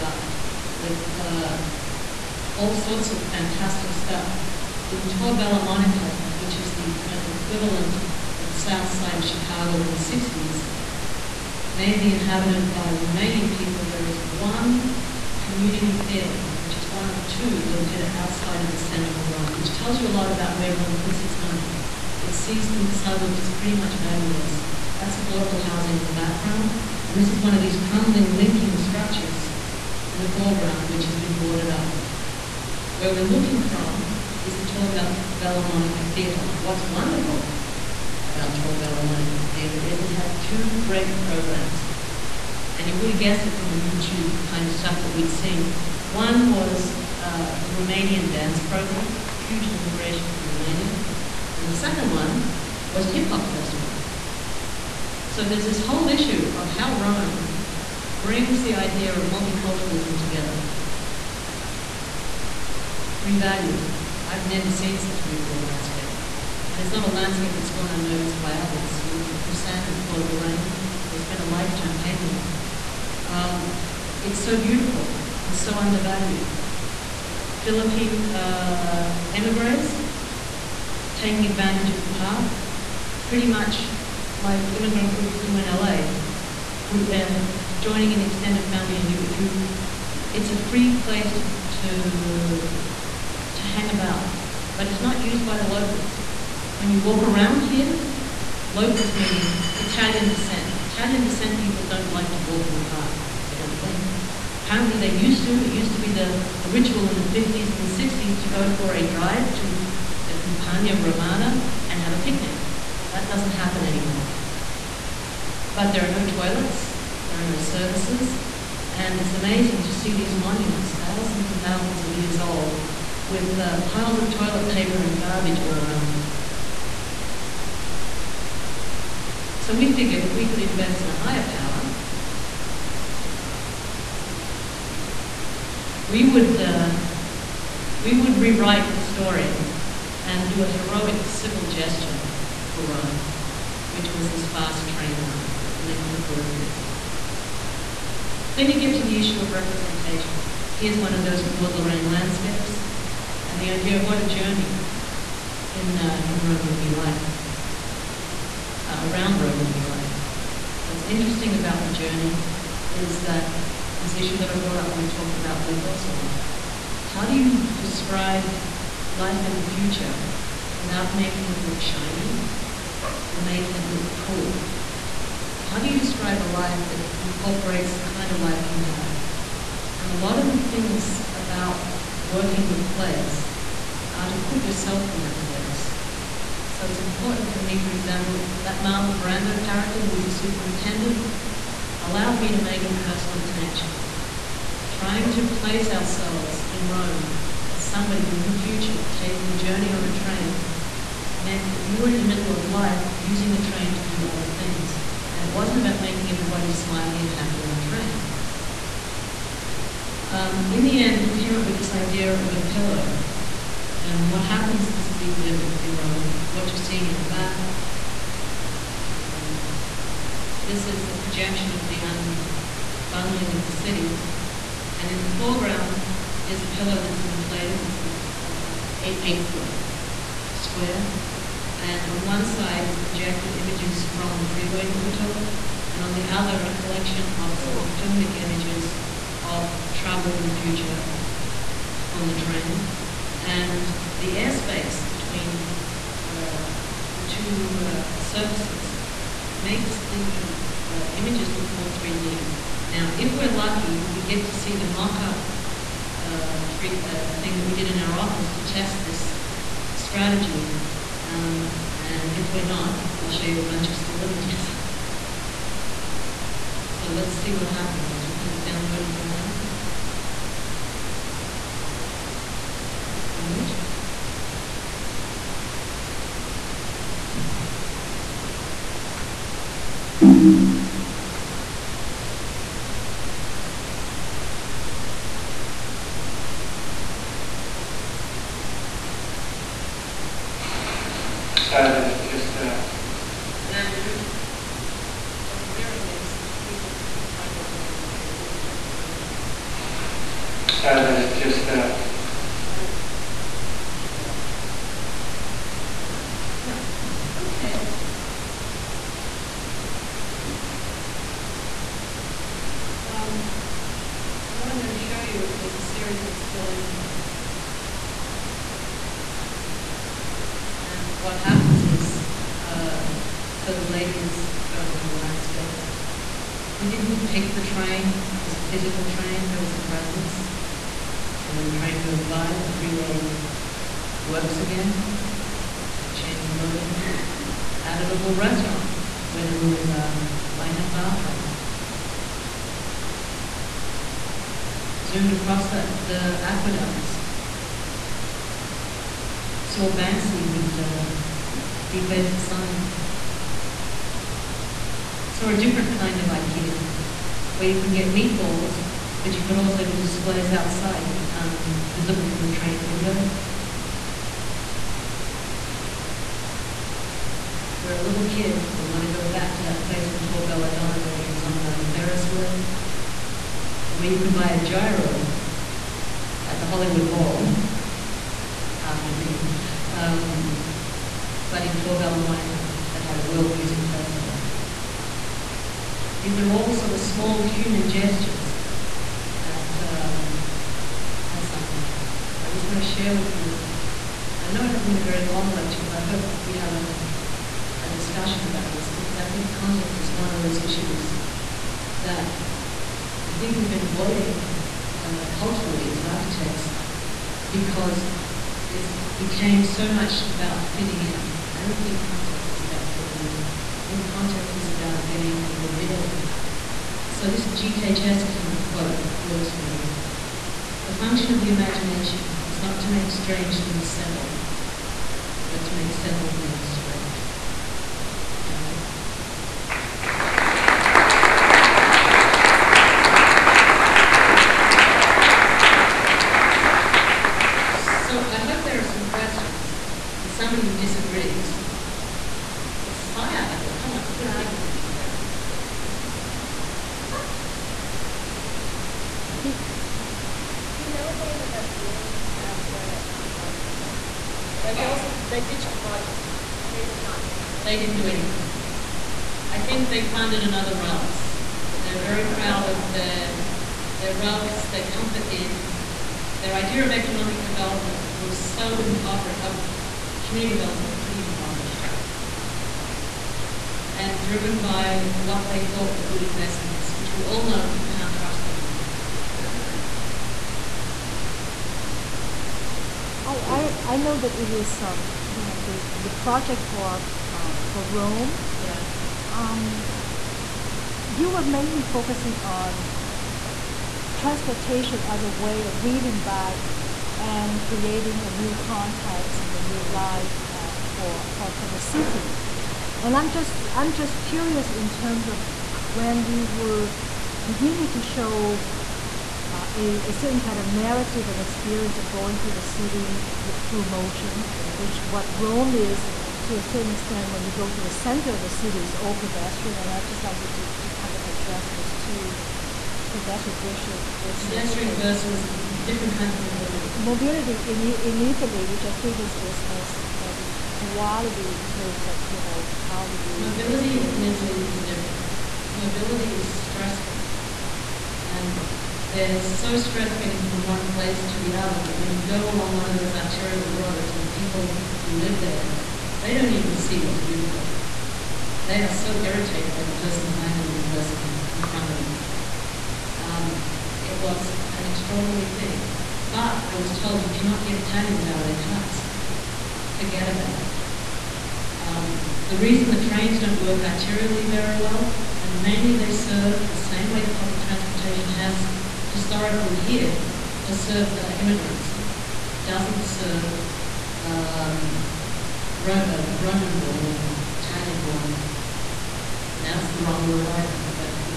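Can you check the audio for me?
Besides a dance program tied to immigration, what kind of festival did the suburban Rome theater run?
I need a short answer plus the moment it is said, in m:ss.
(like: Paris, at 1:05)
Hip hop festival, at 0:53.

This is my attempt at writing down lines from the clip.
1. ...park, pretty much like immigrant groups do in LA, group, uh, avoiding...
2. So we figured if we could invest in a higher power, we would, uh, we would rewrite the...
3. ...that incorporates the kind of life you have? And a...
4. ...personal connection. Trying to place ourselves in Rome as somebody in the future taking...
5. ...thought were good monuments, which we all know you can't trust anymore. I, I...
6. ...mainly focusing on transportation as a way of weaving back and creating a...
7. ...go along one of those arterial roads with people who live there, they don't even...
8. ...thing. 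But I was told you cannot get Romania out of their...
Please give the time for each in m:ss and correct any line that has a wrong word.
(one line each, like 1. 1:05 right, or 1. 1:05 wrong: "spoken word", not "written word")
1. 1:22 wrong: "joining", not "avoiding"
2. 2:09 right
3. 2:56 right
4. 3:13 right
5. 7:55 wrong: "investments", not "monuments"
6. 8:11 right
7. 9:02 right
8. 9:15 wrong: "Italians", not "Romania".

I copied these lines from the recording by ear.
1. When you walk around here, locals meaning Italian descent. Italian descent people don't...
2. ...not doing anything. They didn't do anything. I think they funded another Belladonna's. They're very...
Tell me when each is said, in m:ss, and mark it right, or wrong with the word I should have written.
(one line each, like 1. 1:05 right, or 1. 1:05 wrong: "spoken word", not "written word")
1. 1:36 right
2. 7:37 wrong: "Ralph", not "Belladonna".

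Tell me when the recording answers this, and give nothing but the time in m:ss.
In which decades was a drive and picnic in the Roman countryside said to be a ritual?
1:47.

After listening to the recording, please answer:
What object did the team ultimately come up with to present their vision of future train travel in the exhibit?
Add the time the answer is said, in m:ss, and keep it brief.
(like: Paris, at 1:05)
A pillow, at 3:32.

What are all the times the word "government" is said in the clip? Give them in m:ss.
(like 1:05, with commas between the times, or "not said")
not said.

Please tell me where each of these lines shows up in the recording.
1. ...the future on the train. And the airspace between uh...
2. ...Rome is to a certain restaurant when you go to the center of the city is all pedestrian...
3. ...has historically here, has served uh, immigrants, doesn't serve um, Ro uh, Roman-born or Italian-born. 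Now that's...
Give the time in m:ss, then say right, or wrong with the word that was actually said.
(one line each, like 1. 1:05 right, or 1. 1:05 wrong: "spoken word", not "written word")
1. 4:00 right
2. 8:35 wrong: "extent", not "restaurant"
3. 9:28 right.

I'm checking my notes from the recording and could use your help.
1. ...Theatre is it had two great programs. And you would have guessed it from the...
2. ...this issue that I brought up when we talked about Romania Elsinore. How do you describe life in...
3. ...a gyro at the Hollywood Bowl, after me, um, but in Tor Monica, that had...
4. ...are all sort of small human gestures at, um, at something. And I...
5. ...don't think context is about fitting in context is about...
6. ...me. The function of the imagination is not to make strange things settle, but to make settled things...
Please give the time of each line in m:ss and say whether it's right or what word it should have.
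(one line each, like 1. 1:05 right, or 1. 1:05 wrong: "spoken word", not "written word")
1. 0:39 right
2. 2:44 wrong: "Lake", not "Romania"
3. 6:14 right
4. 6:26 right
5. 6:51 right
6. 6:59 right.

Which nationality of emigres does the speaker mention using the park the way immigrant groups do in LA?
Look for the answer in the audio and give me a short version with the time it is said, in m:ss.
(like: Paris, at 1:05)
Philippine, at 1:17.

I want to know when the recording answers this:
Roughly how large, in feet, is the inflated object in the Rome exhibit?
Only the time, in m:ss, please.
3:49.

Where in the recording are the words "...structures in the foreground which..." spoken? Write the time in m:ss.
0:28.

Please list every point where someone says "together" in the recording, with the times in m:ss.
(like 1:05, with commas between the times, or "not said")
1:00.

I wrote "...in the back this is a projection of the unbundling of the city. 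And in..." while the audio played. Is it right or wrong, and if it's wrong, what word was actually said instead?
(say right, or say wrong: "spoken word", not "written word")
right.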